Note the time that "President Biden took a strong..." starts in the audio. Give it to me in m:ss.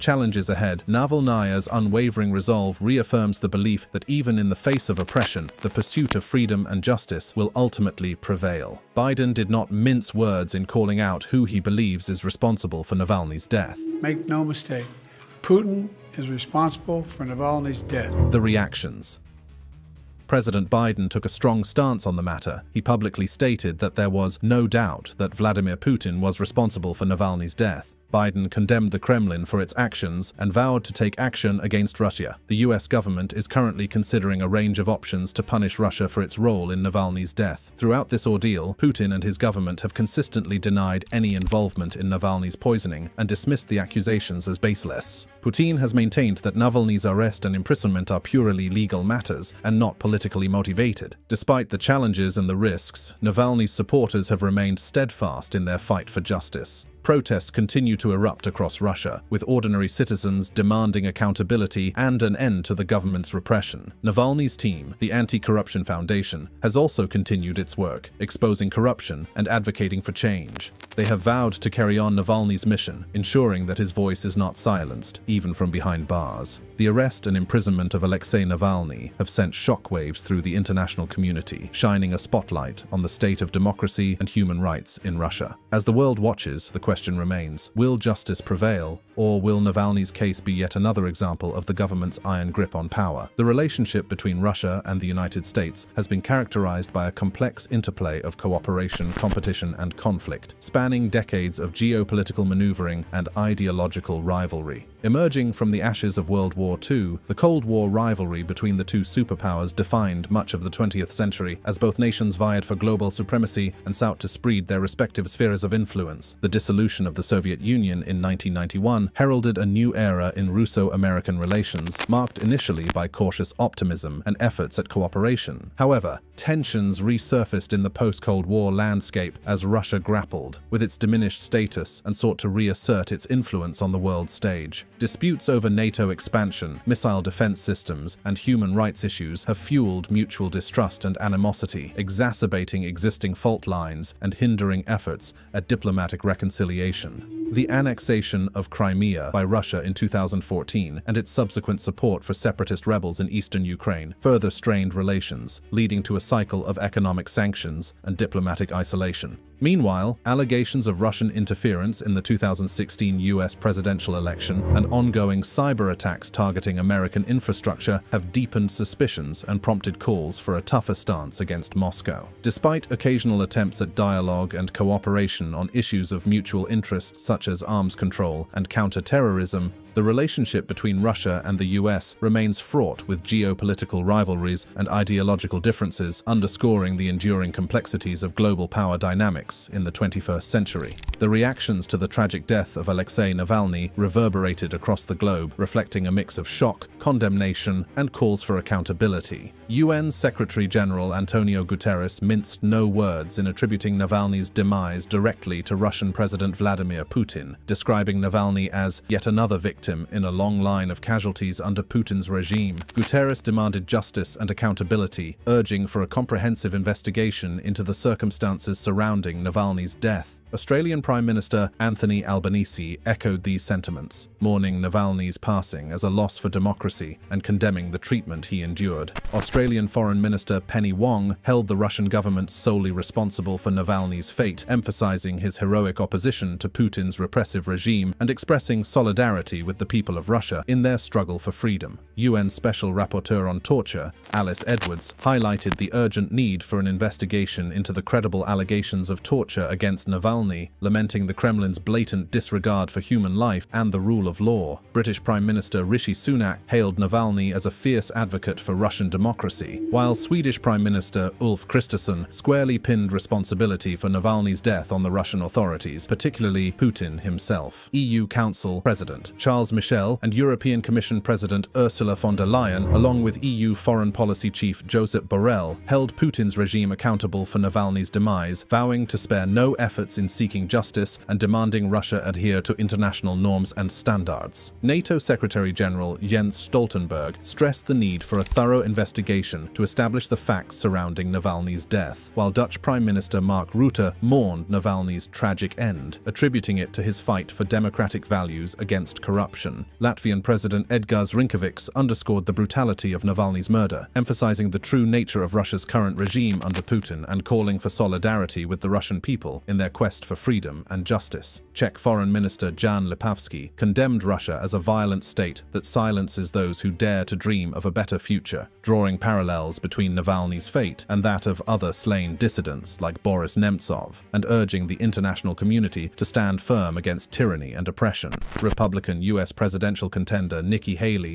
0:20.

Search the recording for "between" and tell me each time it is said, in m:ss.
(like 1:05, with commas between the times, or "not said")
1:34, 1:48, 3:00, 5:19.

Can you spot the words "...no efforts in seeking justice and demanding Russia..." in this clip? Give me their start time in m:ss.
4:39.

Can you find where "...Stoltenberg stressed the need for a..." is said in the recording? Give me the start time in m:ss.
4:46.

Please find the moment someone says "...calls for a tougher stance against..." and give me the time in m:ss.
2:49.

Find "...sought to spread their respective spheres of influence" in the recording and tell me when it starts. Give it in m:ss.
1:53.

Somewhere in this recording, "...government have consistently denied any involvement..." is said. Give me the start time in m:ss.
0:39.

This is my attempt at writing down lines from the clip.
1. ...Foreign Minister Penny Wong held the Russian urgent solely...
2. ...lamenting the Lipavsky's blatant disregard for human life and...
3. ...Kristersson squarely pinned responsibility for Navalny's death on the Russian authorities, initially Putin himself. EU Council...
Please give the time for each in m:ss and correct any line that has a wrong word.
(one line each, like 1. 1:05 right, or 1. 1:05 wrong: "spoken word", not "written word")
1. 3:49 wrong: "government", not "urgent"
2. 4:10 wrong: "Kremlin", not "Lipavsky"
3. 4:21 wrong: "particularly", not "initially".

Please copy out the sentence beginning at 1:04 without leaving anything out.
Navalny's team, the Anti-Corruption Foundation, has also continued its work, exposing corruption and advocating for change.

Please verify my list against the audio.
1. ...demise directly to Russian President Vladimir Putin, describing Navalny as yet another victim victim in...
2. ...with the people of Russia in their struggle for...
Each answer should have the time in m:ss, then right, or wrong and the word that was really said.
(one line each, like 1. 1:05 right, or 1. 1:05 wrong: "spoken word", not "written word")
1. 3:24 right
2. 3:59 right.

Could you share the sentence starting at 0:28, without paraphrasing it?
Biden condemned the Kremlin for its actions and vowed to take action against Russia.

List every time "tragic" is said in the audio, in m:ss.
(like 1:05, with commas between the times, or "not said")
3:12, 4:55.